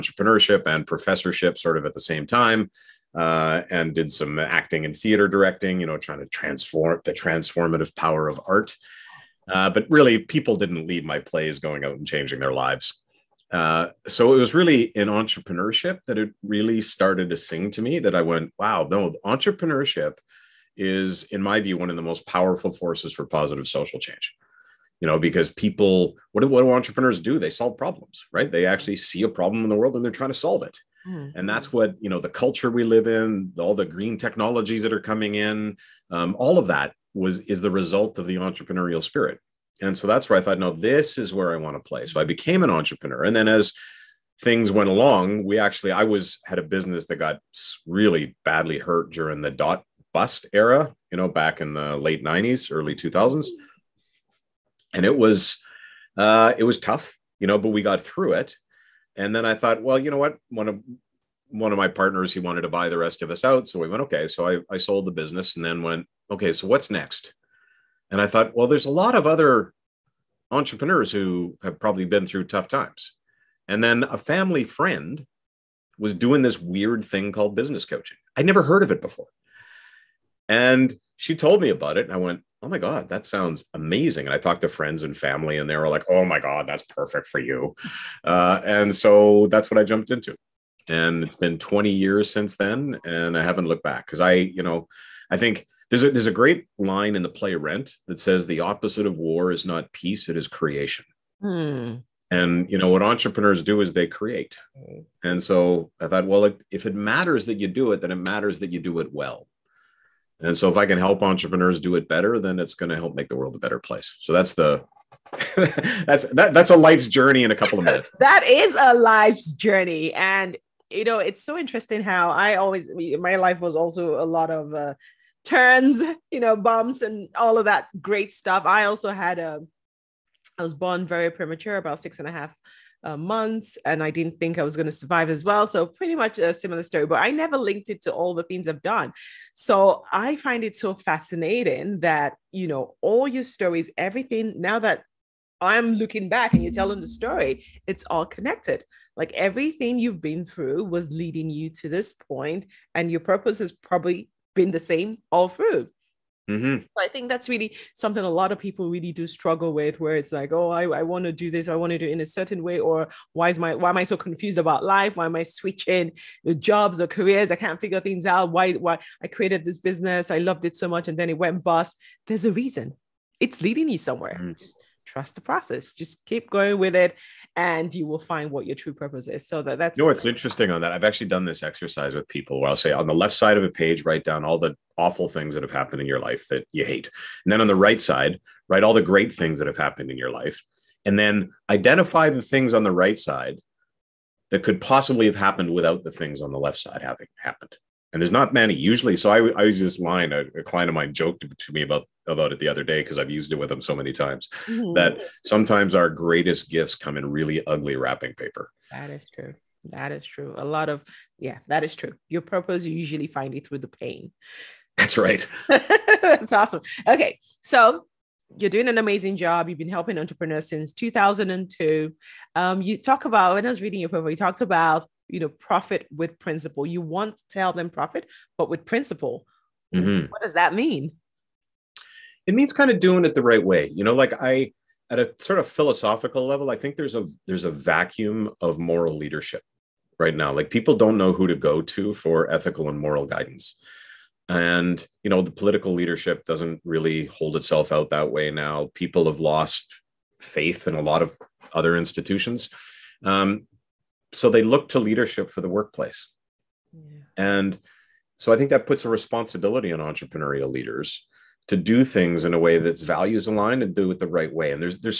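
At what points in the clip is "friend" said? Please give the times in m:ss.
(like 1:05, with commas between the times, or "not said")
1:14, 1:24.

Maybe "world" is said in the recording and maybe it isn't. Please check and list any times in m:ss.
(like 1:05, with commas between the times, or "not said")
0:29, 1:53.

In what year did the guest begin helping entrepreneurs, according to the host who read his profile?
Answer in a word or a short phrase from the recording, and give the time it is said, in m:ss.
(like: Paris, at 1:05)
2002, at 3:40.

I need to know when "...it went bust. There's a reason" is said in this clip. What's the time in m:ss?
2:51.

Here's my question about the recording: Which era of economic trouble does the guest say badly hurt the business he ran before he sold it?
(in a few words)
dot bust era.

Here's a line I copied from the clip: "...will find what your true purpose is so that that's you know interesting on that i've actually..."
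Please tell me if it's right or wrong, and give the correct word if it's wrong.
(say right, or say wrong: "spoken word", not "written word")
right.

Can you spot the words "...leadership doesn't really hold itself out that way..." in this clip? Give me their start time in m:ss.
4:05.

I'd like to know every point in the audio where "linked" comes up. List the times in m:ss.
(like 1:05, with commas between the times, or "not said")
2:17.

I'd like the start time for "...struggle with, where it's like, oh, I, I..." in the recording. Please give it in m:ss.
2:39.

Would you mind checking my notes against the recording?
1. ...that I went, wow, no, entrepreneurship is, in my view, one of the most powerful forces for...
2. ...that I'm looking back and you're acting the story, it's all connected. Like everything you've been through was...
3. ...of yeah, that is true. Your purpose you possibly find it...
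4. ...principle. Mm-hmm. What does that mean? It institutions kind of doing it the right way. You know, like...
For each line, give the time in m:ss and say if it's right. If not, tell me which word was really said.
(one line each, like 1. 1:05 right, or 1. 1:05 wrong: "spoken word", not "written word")
1. 0:17 right
2. 2:24 wrong: "telling", not "acting"
3. 3:30 wrong: "usually", not "possibly"
4. 3:48 wrong: "means", not "institutions".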